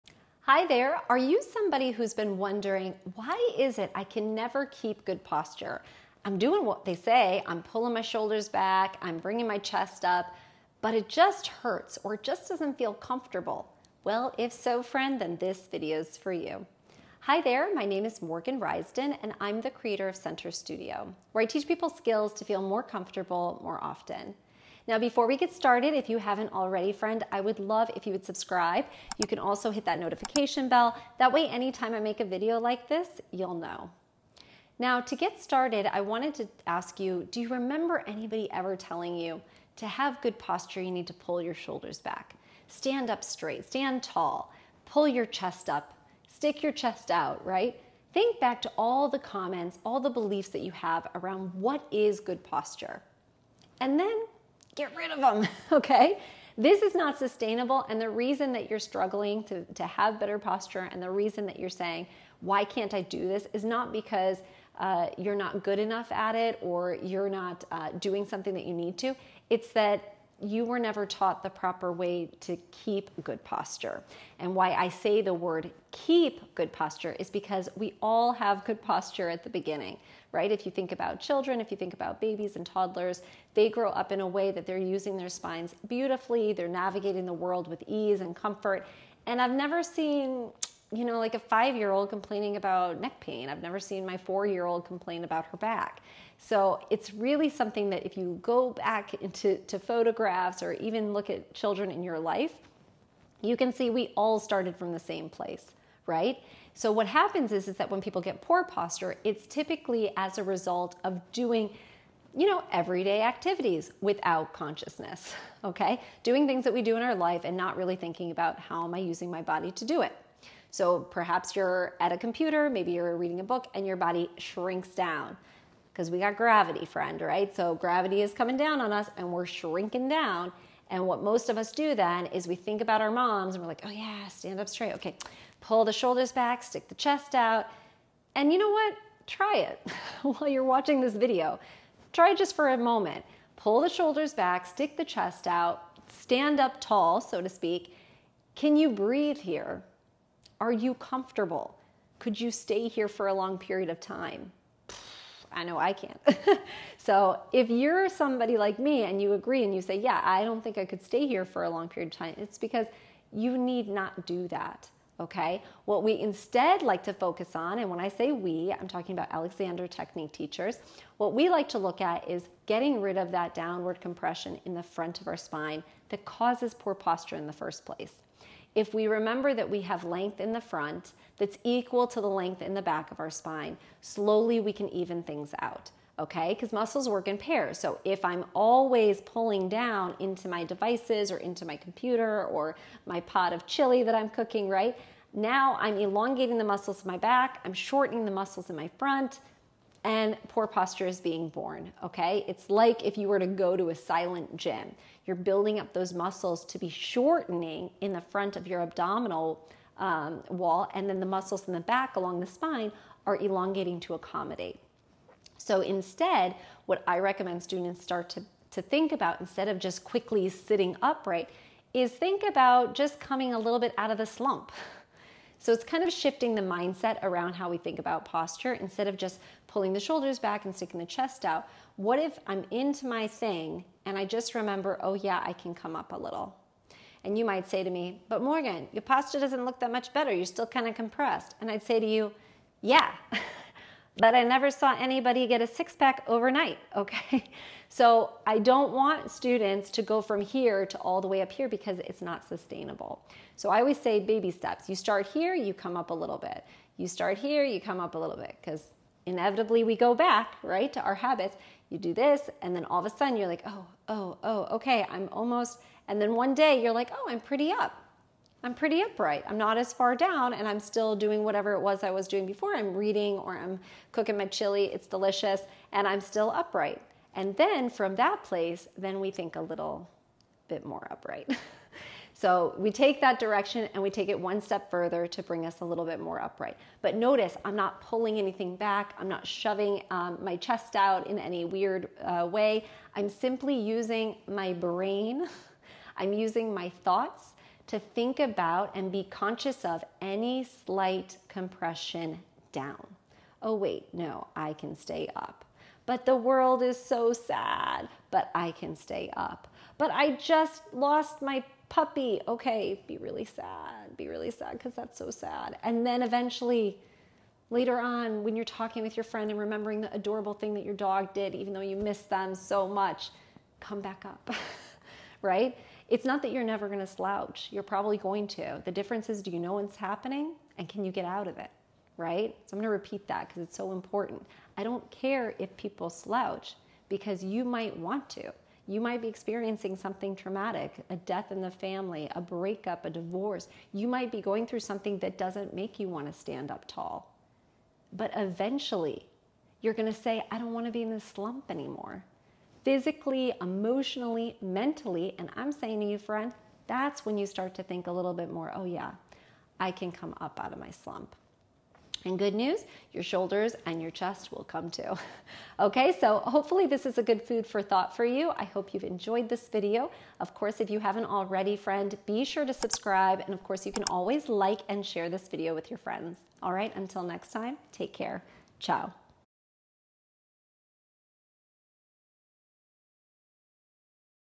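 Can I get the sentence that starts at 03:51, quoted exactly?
What if I'm into my thing and I just remember, oh, yeah, I can come up a little?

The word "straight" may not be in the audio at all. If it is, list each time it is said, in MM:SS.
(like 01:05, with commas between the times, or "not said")
00:43, 02:14.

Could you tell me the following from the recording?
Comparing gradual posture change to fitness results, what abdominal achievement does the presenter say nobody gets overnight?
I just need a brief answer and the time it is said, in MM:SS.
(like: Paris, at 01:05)
a six pack, at 04:05.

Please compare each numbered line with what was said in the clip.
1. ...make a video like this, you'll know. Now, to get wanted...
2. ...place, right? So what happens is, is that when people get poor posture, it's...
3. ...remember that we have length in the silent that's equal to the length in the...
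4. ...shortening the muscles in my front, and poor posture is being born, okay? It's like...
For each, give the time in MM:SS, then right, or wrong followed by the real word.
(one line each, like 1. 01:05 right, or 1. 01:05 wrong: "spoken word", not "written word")
1. 00:31 wrong: "started", not "wanted"
2. 01:45 right
3. 02:59 wrong: "front", not "silent"
4. 03:17 right.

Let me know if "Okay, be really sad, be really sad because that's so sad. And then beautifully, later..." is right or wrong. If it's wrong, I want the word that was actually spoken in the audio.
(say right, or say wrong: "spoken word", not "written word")
wrong: "eventually", not "beautifully".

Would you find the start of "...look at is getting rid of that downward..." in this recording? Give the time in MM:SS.
02:51.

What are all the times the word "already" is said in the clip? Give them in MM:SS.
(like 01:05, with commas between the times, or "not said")
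00:26, 06:11.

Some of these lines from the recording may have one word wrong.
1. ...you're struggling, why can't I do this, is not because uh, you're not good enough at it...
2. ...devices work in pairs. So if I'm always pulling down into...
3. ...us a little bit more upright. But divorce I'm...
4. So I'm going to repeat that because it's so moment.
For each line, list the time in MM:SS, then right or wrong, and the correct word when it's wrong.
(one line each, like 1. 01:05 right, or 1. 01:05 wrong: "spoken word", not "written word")
1. 01:01 wrong: "saying", not "struggling"
2. 03:06 wrong: "muscles", not "devices"
3. 04:45 wrong: "notice", not "divorce"
4. 05:32 wrong: "important", not "moment".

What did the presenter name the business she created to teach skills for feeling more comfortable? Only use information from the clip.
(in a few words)
Center Studio.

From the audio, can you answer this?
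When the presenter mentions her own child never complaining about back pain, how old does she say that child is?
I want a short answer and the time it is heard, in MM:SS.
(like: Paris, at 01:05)
4, at 01:34.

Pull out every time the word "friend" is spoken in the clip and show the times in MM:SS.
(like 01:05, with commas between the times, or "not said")
00:14, 00:26, 02:06, 05:19, 05:56, 06:11, 06:15.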